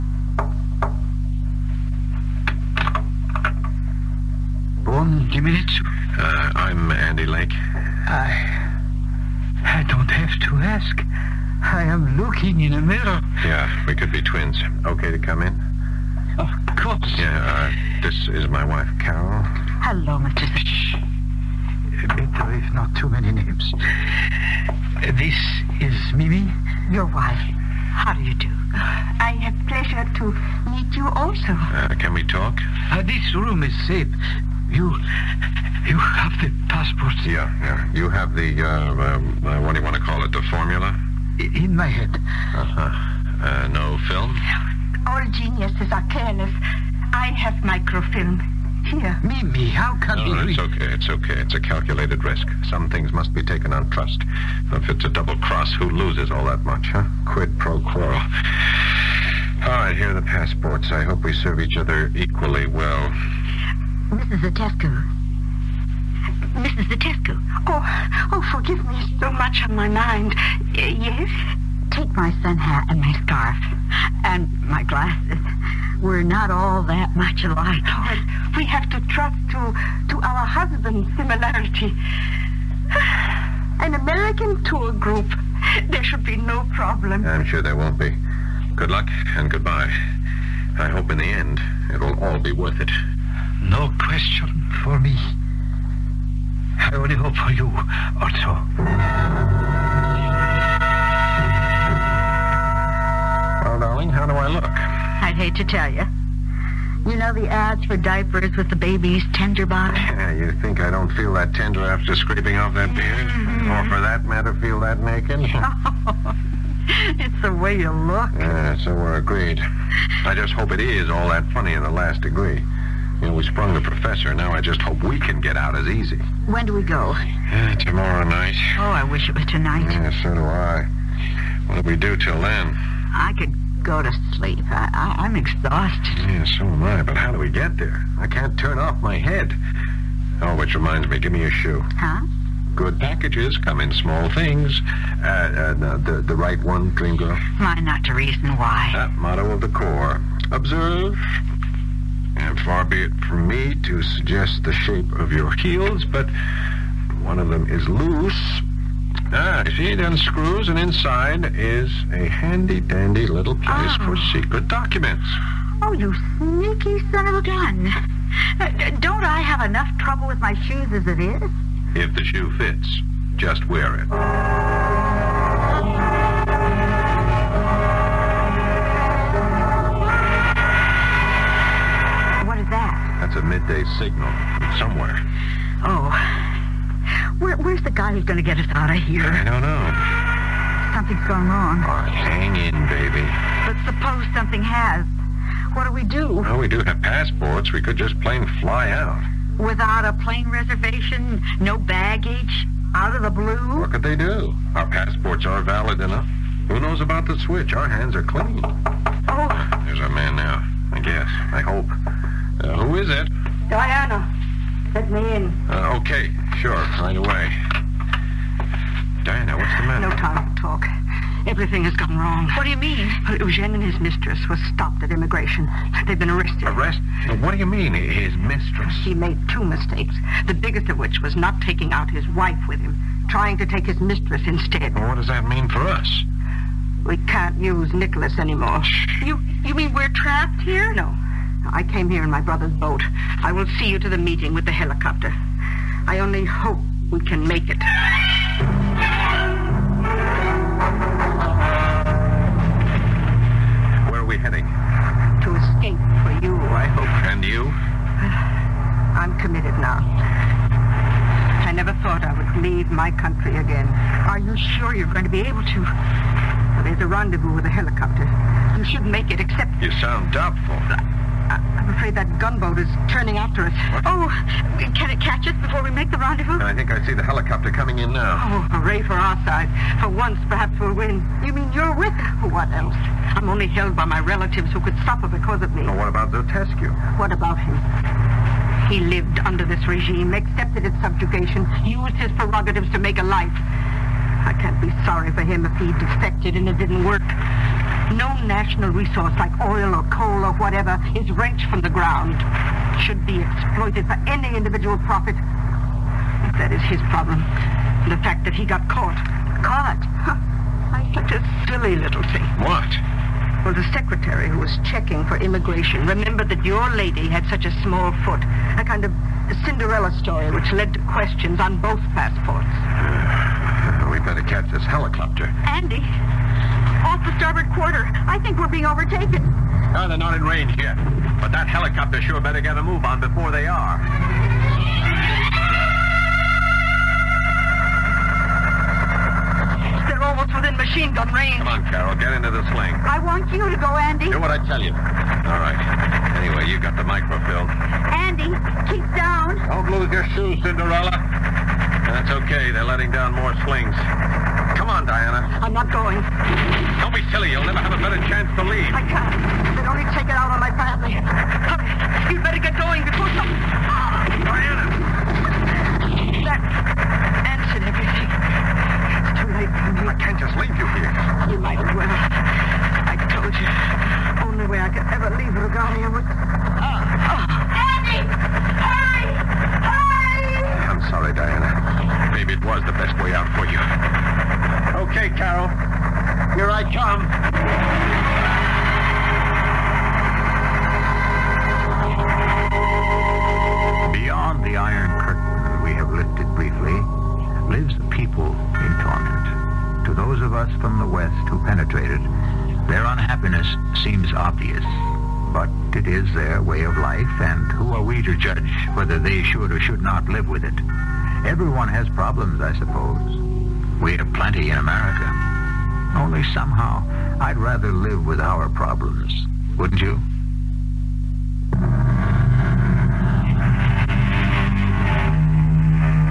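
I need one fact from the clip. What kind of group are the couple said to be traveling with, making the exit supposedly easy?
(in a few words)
An American tour group.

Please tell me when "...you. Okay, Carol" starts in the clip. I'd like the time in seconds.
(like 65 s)
383 s.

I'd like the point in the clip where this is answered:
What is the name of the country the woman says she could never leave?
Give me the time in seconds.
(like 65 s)
375 s.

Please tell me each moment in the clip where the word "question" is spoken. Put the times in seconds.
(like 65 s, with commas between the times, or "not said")
93 s, 321 s.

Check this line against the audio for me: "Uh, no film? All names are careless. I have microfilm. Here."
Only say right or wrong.
wrong.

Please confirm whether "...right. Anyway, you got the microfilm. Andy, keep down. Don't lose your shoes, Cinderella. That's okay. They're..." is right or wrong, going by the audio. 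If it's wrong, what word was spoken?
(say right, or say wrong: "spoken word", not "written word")
right.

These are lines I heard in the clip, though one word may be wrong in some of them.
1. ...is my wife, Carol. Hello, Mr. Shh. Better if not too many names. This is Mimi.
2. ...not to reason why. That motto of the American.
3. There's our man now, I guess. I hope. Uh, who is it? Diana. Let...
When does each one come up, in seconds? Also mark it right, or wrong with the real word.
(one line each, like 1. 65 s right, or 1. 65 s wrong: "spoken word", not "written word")
1. 18 s right
2. 147 s wrong: "Corps", not "American"
3. 209 s right.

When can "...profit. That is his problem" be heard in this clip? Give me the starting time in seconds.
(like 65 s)
304 s.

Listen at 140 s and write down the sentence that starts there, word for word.
Oh, which reminds me, give me your shoe.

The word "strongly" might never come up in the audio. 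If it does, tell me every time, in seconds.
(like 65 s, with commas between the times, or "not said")
not said.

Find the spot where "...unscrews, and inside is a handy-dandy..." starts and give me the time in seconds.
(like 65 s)
159 s.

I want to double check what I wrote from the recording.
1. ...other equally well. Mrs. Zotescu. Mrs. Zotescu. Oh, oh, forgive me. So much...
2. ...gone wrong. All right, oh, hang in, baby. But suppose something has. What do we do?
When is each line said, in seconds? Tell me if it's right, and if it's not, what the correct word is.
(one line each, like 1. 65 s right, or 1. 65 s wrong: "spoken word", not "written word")
1. 61 s right
2. 191 s right.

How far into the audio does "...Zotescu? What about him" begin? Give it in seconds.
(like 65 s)
286 s.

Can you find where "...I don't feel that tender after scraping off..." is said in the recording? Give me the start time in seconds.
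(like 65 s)
110 s.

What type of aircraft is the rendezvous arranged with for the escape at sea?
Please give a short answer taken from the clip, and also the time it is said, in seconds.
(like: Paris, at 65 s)
A helicopter, at 267 s.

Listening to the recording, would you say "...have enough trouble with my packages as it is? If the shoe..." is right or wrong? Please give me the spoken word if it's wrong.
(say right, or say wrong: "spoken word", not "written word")
wrong: "shoes", not "packages".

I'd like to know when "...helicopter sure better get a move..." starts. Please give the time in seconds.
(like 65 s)
331 s.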